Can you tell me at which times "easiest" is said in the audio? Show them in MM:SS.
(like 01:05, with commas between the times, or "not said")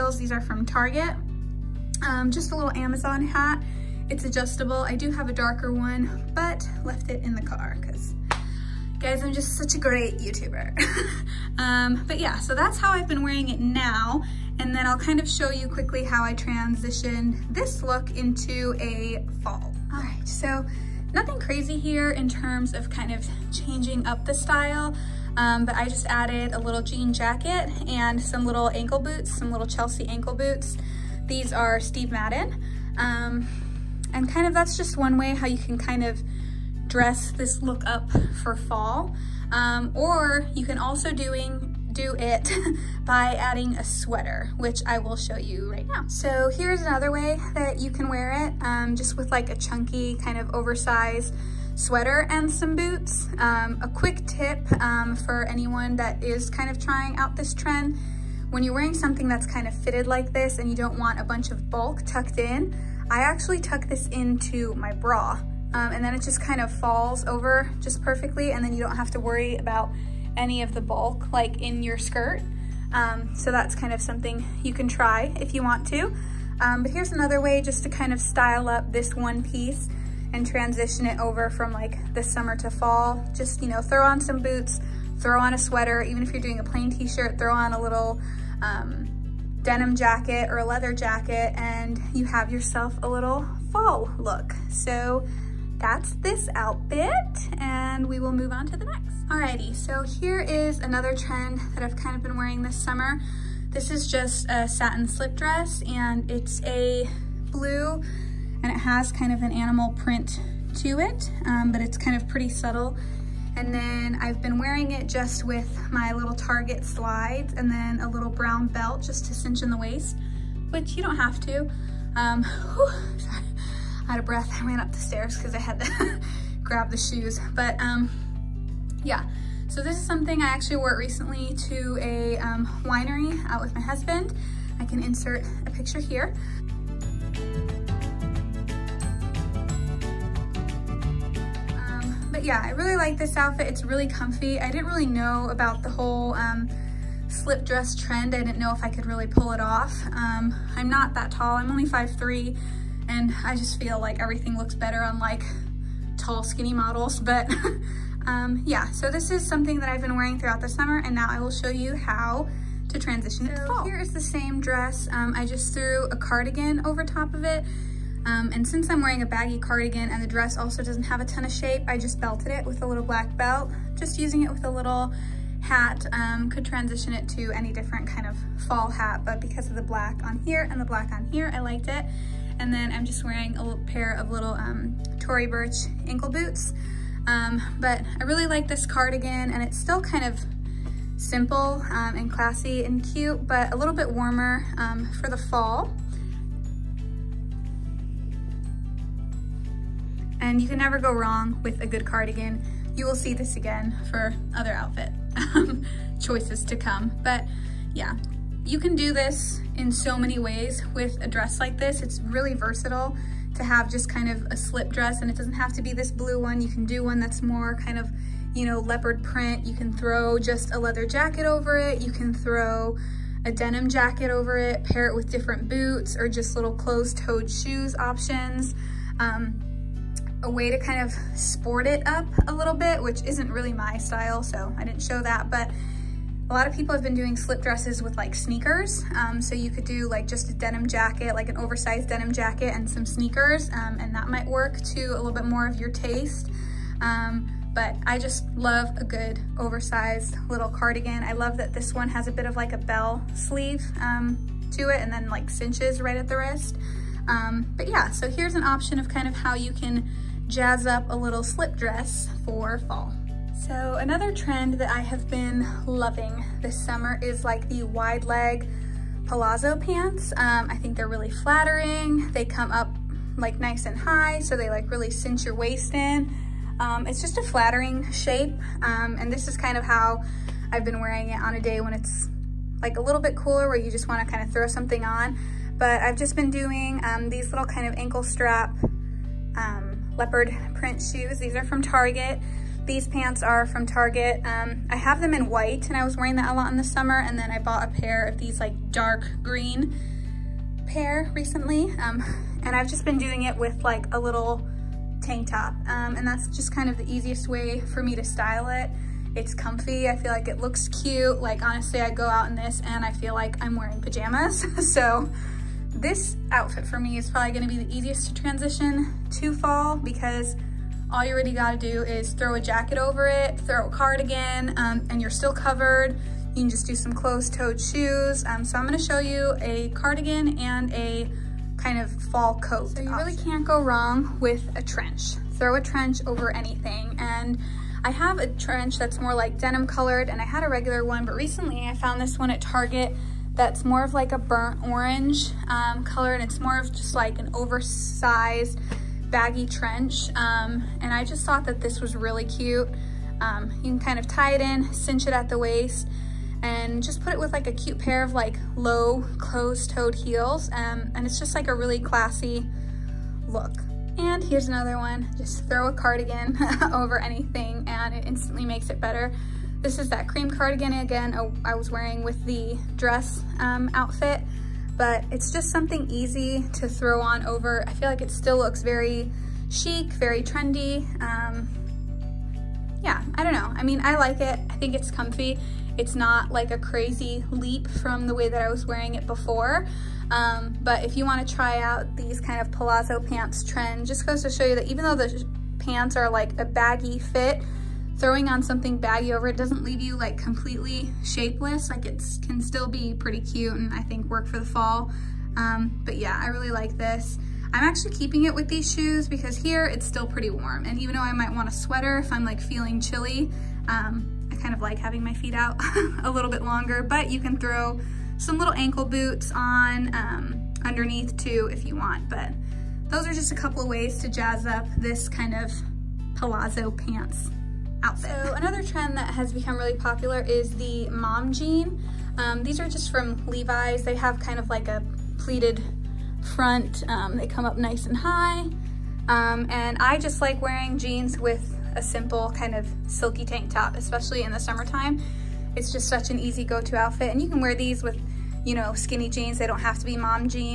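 05:07, 05:17.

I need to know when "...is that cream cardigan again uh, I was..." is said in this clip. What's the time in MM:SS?
06:09.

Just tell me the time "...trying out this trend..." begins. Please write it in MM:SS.
00:56.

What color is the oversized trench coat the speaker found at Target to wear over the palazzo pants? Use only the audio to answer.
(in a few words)
burnt orange.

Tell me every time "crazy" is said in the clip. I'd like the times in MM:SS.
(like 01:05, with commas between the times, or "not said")
00:21, 06:26.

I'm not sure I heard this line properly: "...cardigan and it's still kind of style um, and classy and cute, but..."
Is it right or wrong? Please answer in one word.
wrong.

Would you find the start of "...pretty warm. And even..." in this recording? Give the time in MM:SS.
06:50.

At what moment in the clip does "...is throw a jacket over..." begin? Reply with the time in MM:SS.
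05:22.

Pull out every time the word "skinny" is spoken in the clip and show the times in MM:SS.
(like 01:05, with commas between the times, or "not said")
02:36, 07:28.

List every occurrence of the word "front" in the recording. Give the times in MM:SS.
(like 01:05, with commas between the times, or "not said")
07:16.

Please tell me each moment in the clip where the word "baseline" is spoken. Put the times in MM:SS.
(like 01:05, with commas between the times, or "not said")
not said.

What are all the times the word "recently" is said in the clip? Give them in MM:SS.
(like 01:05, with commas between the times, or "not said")
02:10, 05:01, 05:41.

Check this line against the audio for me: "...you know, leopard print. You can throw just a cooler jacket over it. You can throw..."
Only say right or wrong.
wrong.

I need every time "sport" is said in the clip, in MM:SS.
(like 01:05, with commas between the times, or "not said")
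03:51.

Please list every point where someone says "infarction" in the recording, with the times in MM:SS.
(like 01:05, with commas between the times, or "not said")
not said.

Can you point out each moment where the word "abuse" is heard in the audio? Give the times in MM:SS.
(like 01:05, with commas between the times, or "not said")
not said.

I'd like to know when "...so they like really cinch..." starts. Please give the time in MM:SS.
04:34.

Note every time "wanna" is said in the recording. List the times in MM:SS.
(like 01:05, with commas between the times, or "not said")
04:44, 06:31.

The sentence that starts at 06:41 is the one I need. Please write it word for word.
Like it can still be pretty cute and I think work for the fall.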